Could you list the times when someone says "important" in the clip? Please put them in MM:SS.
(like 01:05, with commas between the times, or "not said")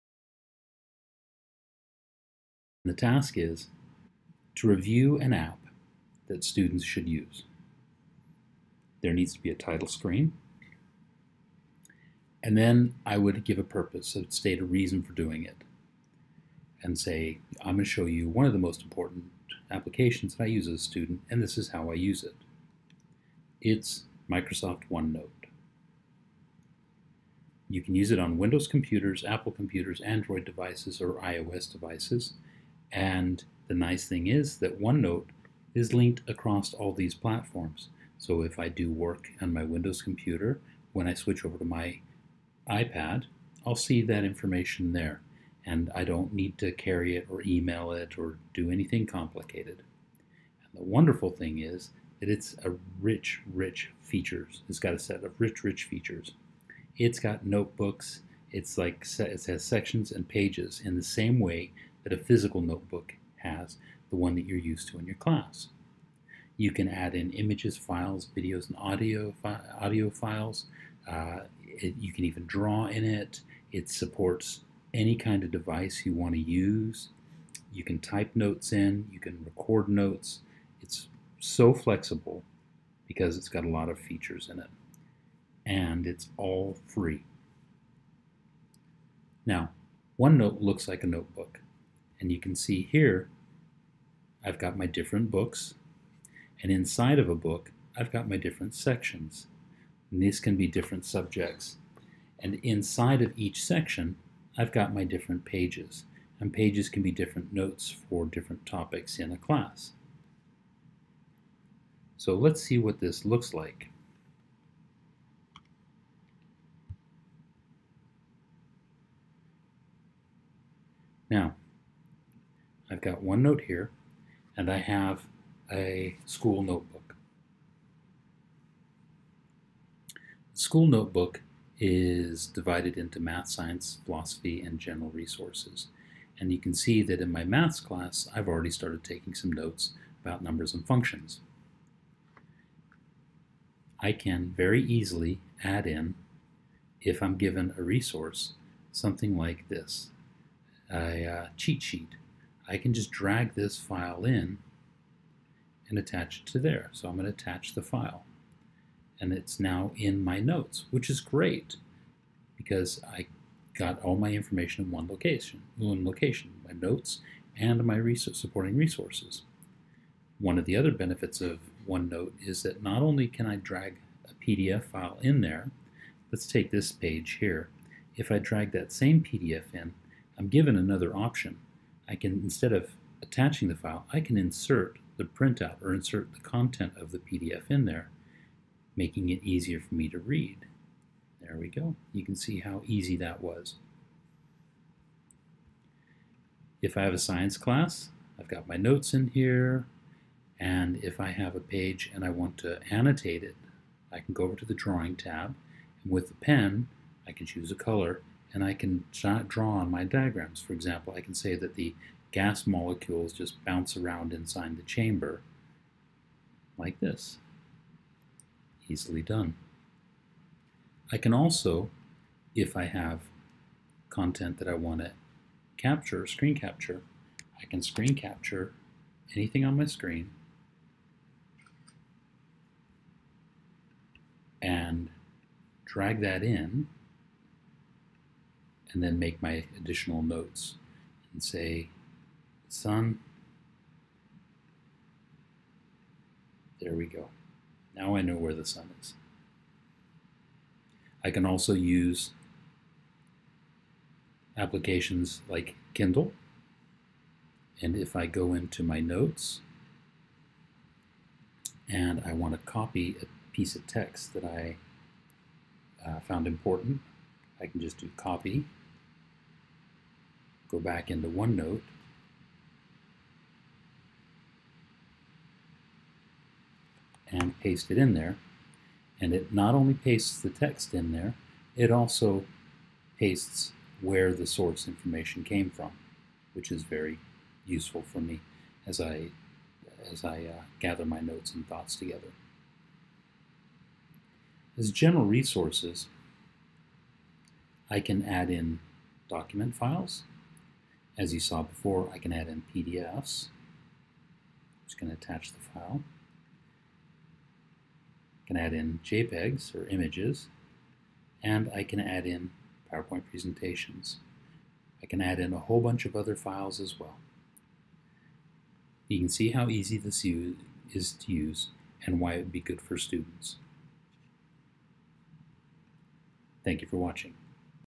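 00:18, 04:26.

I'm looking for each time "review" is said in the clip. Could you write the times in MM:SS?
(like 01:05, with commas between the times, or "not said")
00:04.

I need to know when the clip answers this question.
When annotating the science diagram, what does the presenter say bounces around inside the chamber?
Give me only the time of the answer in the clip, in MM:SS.
03:32.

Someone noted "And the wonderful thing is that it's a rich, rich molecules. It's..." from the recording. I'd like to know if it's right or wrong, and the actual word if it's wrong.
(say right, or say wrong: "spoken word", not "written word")
wrong: "features", not "molecules".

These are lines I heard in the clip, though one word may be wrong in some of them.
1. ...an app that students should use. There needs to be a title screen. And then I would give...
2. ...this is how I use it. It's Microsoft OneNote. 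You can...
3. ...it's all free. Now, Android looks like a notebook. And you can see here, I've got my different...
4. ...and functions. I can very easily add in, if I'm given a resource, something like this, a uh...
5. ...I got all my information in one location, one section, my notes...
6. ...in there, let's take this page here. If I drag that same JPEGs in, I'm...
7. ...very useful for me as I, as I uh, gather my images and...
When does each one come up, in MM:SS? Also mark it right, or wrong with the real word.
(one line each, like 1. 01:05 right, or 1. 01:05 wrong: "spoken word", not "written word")
1. 00:05 right
2. 00:21 right
3. 01:26 wrong: "OneNote", not "Android"
4. 02:20 right
5. 02:43 wrong: "location", not "section"
6. 02:55 wrong: "PDF", not "JPEGs"
7. 04:46 wrong: "notes", not "images".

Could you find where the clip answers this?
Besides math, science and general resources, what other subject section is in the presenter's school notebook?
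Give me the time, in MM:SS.
02:14.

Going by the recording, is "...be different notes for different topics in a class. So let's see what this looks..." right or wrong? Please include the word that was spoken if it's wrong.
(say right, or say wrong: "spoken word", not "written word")
right.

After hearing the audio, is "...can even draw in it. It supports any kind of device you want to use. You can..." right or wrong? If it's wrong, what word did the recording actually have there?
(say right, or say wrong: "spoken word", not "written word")
right.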